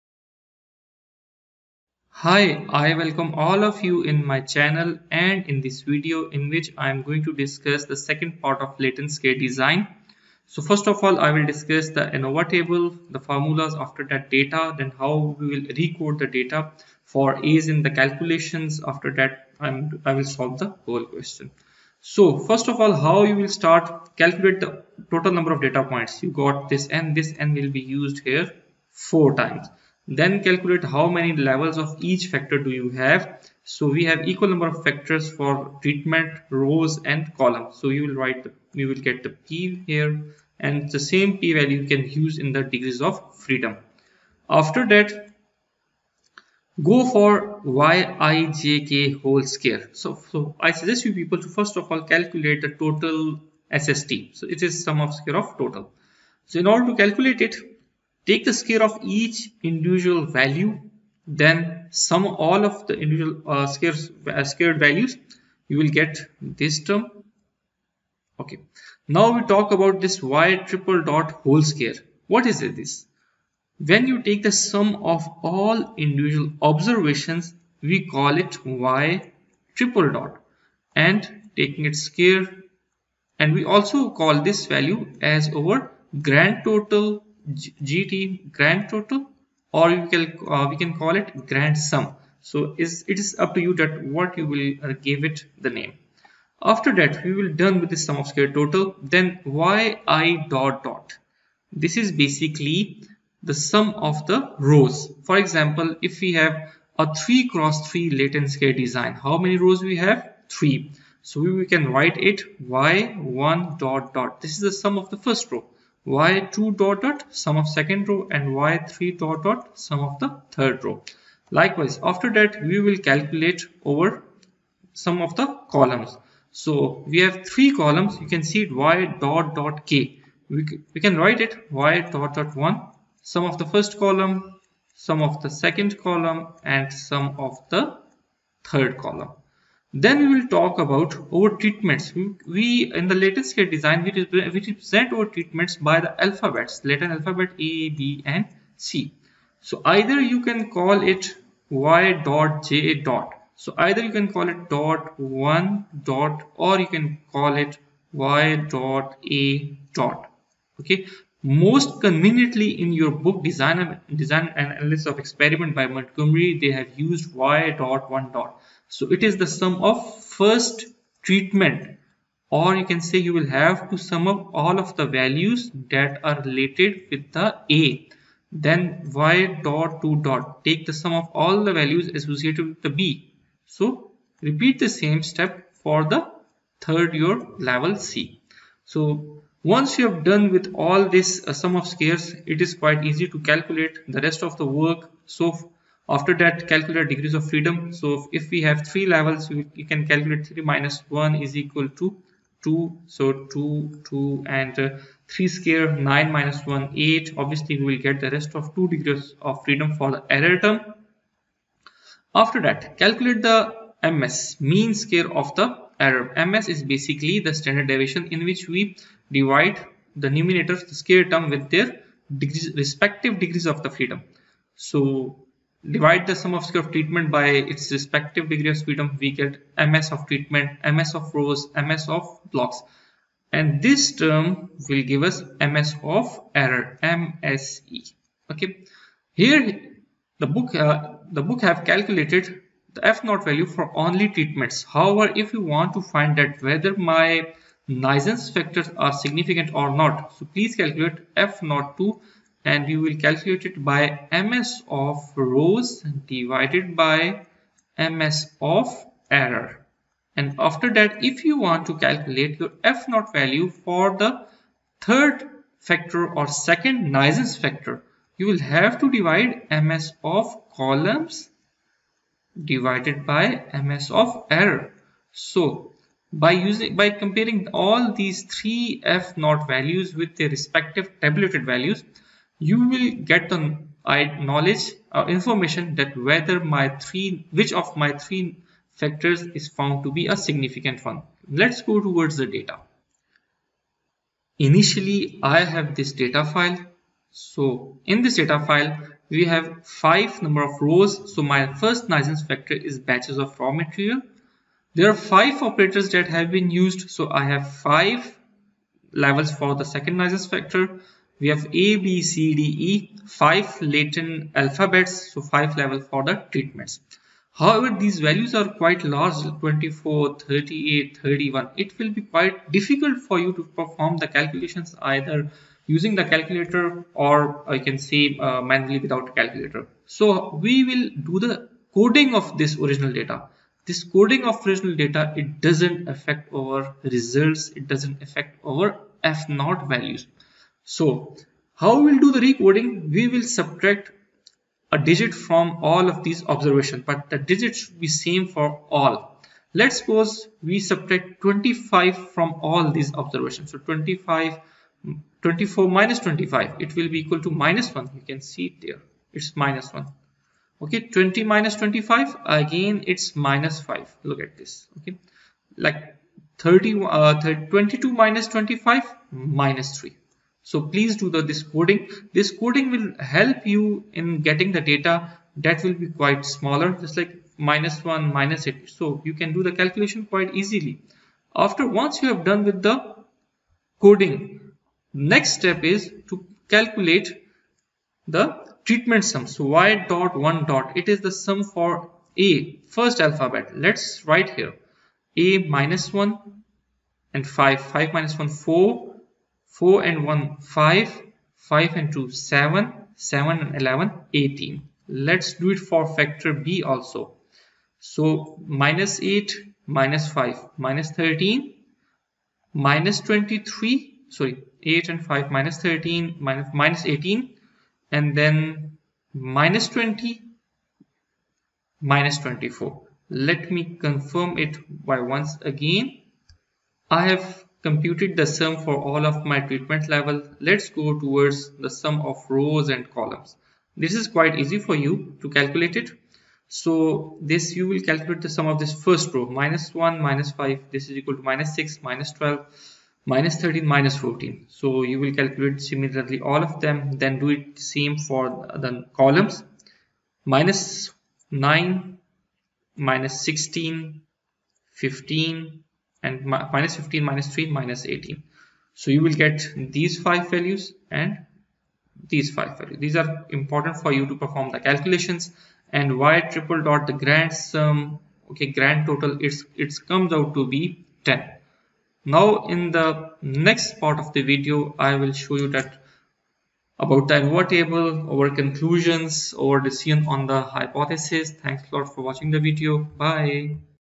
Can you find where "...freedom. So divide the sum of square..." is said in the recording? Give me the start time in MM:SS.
03:43.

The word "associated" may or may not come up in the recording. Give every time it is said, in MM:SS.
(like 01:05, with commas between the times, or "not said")
03:02.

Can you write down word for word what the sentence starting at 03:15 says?
So after that, calculate degrees of freedom.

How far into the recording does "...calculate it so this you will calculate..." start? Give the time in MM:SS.
07:15.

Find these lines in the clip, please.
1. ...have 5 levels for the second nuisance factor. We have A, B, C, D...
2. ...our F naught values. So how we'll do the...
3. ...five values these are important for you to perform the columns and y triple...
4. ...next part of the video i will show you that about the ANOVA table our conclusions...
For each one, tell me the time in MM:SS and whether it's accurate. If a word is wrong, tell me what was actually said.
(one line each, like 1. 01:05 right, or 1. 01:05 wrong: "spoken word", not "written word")
1. 05:07 right
2. 05:38 right
3. 07:42 wrong: "calculations", not "columns"
4. 07:53 right.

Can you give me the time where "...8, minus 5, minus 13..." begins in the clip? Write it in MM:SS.
06:49.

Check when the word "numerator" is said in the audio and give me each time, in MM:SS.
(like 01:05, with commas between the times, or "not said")
03:40.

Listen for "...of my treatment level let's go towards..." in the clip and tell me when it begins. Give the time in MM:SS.
07:09.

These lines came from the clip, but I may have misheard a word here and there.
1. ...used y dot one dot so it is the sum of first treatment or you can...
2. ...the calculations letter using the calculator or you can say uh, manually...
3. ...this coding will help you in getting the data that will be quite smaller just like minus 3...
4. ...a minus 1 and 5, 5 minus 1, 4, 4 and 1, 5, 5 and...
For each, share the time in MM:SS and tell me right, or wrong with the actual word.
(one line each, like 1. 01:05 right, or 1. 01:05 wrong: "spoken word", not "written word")
1. 02:46 right
2. 05:24 wrong: "either", not "letter"
3. 06:12 wrong: "1", not "3"
4. 06:35 right.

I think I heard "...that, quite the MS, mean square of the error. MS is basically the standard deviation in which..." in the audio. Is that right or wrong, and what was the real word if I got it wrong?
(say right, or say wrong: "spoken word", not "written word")
wrong: "calculate", not "quite".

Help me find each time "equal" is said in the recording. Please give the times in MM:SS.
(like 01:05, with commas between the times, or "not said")
00:34, 03:21, 05:57, 07:21.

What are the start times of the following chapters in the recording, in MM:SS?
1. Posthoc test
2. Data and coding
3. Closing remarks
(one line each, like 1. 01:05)
1. 00:23
2. 04:53
3. 07:53.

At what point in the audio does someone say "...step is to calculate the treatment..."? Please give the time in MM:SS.
06:25.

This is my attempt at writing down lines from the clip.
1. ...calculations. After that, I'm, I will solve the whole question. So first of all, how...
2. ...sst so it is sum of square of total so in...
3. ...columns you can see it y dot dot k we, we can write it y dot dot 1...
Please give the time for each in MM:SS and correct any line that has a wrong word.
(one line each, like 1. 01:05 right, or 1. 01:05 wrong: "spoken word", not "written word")
1. 00:17 right
2. 00:53 right
3. 02:07 right.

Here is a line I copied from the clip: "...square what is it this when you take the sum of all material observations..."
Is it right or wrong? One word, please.
wrong.